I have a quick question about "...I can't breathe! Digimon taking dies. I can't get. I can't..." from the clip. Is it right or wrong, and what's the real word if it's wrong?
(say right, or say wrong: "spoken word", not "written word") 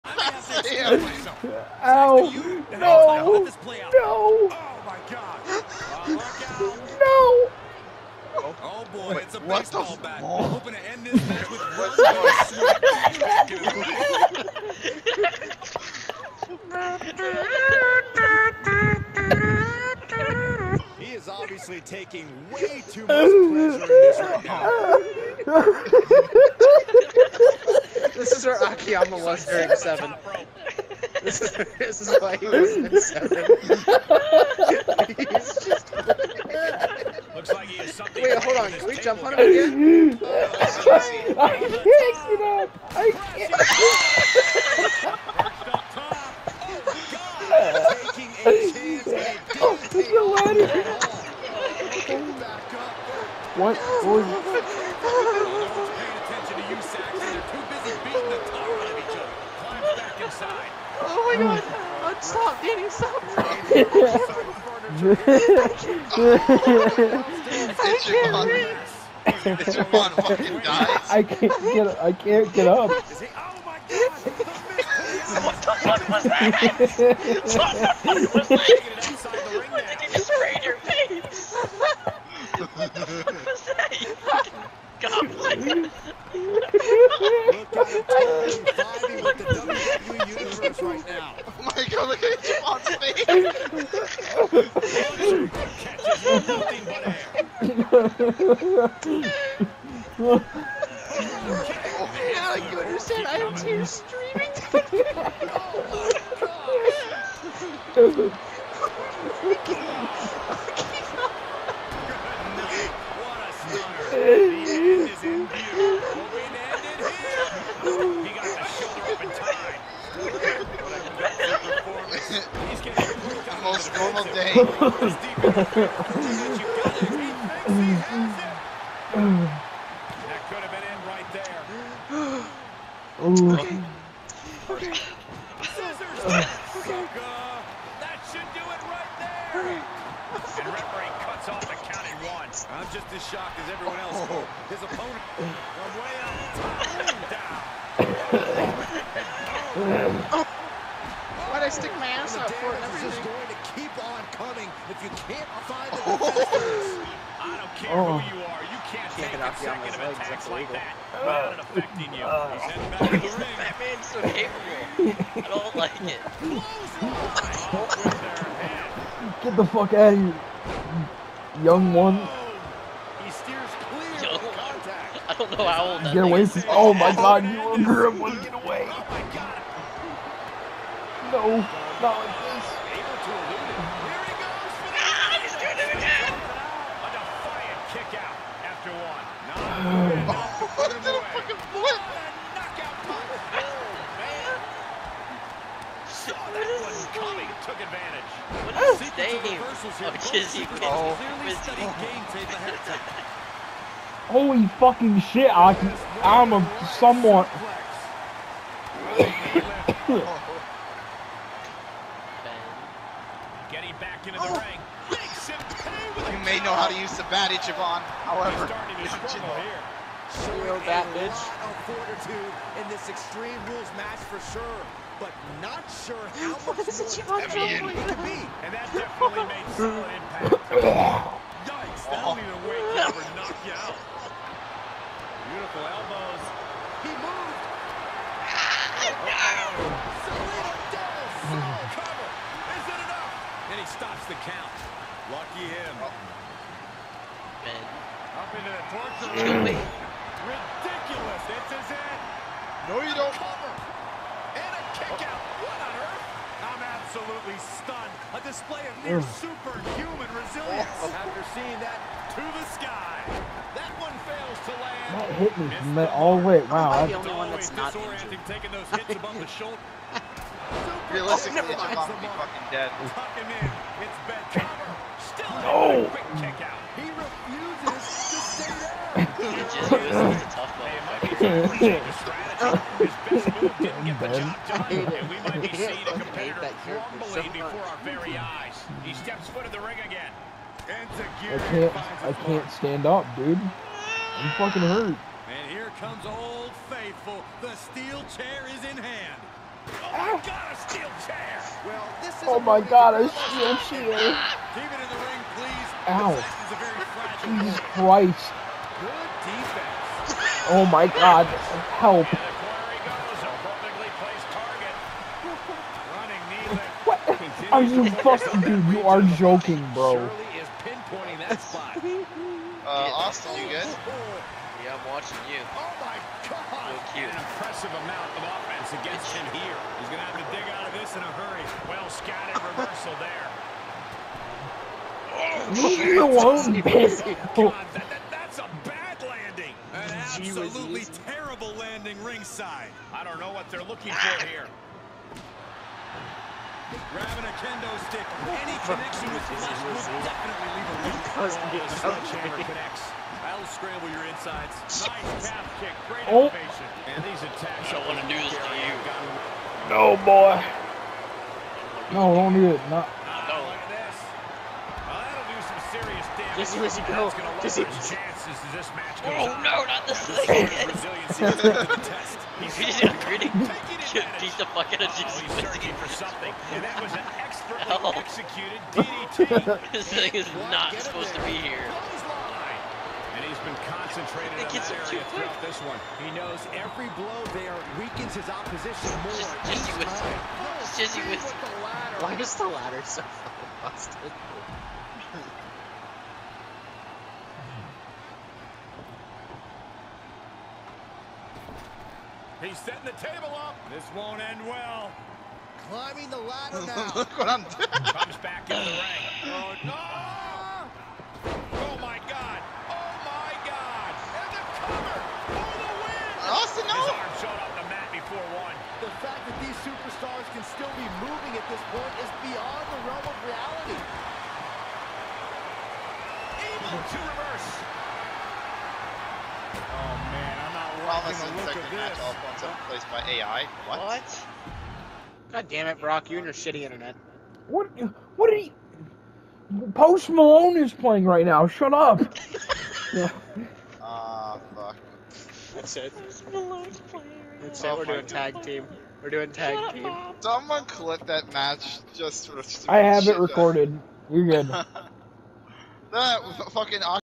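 wrong: "fucking", not "taking".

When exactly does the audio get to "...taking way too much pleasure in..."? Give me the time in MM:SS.
00:21.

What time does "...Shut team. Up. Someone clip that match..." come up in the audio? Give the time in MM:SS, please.
07:29.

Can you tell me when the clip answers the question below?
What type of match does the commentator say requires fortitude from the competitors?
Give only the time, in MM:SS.
03:43.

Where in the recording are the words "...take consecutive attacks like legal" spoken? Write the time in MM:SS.
02:39.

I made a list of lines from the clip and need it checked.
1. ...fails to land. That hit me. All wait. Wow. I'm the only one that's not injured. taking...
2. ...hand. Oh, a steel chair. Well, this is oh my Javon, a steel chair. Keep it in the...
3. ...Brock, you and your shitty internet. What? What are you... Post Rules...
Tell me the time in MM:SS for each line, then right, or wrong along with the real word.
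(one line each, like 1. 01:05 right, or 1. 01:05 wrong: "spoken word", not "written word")
1. 04:24 right
2. 04:59 wrong: "God", not "Javon"
3. 07:15 wrong: "Malone", not "Rules".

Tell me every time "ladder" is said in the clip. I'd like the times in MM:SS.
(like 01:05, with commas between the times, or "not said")
06:32, 06:46.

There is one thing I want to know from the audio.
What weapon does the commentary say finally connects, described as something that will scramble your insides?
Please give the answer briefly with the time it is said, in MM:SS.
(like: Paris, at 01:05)
Sledgehammer, at 05:51.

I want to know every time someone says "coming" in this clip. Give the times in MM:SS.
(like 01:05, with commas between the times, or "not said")
02:34.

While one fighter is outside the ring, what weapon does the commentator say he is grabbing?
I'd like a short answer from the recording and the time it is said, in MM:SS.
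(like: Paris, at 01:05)
Kendo stick, at 05:47.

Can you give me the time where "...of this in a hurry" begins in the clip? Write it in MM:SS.
05:30.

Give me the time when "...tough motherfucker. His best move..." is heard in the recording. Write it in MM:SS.
04:40.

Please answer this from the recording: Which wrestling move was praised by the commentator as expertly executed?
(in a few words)
DDT.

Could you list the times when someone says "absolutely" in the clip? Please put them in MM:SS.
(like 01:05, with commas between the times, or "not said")
04:16, 05:40.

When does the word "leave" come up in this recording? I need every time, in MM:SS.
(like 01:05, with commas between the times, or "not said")
05:35, 05:50.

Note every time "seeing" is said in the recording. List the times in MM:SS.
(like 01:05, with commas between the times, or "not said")
04:21, 04:45.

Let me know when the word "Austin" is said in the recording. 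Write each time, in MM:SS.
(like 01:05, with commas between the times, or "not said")
05:23, 06:56.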